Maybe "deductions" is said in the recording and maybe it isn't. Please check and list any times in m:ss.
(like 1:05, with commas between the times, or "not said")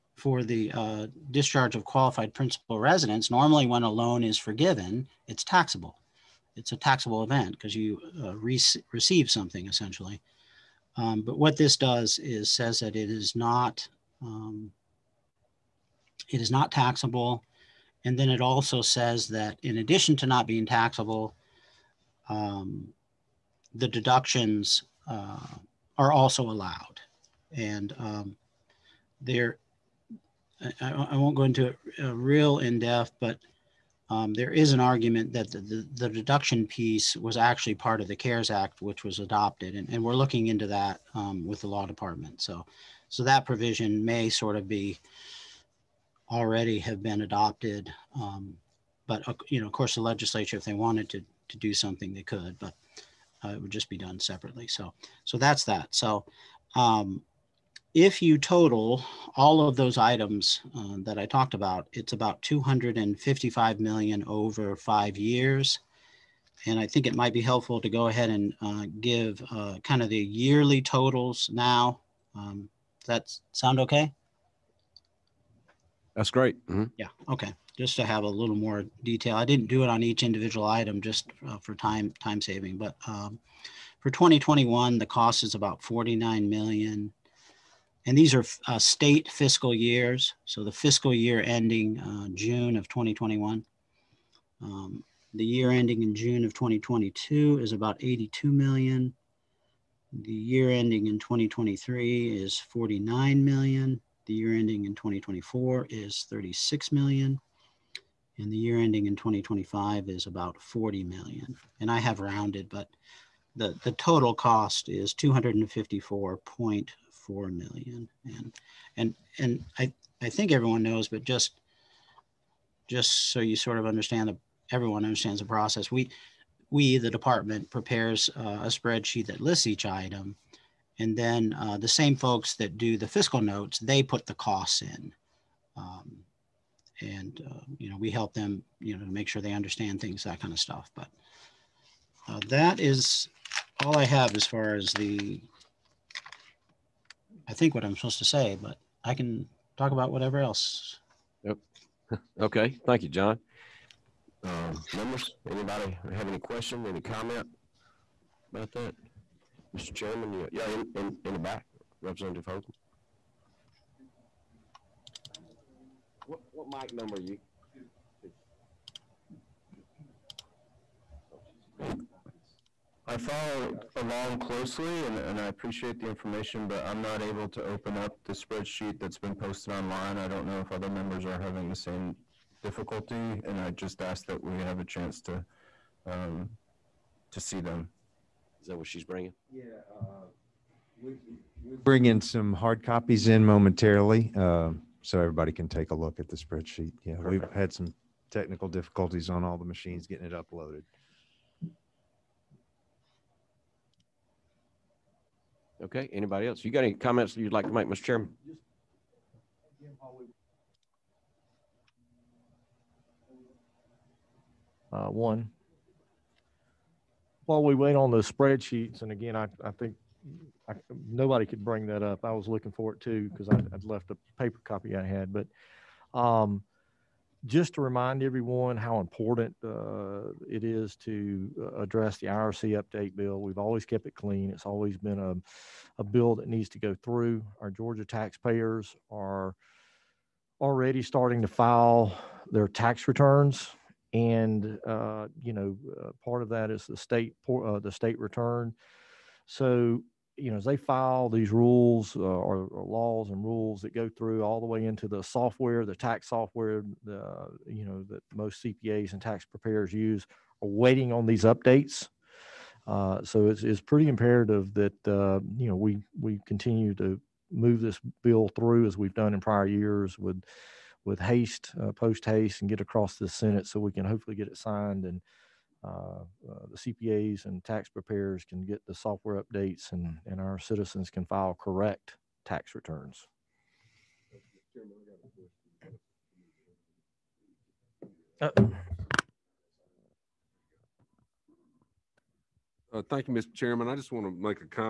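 0:23, 0:36.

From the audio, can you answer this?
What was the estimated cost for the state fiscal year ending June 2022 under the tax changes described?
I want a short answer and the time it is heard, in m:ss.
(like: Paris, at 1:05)
82 million, at 1:37.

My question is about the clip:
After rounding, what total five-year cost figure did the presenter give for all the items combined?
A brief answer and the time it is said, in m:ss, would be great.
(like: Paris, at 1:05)
254.4 million, at 1:55.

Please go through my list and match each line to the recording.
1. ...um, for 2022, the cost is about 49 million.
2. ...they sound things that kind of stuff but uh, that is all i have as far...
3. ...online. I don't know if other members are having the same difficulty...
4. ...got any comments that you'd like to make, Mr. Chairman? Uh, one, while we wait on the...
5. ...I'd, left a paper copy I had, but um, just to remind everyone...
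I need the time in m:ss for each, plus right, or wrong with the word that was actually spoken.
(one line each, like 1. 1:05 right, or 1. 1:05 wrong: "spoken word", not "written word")
1. 1:23 wrong: "2021", not "2022"
2. 2:19 wrong: "understand", not "sound"
3. 2:59 right
4. 3:26 right
5. 3:43 right.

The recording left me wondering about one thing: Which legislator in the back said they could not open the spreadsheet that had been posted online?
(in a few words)
Representative Hope.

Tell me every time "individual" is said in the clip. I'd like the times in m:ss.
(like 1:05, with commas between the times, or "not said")
1:20.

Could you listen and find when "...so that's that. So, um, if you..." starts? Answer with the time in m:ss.
0:55.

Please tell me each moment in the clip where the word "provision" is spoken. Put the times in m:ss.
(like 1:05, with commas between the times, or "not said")
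0:43.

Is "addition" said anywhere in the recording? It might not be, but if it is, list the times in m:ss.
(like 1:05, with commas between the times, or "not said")
0:19.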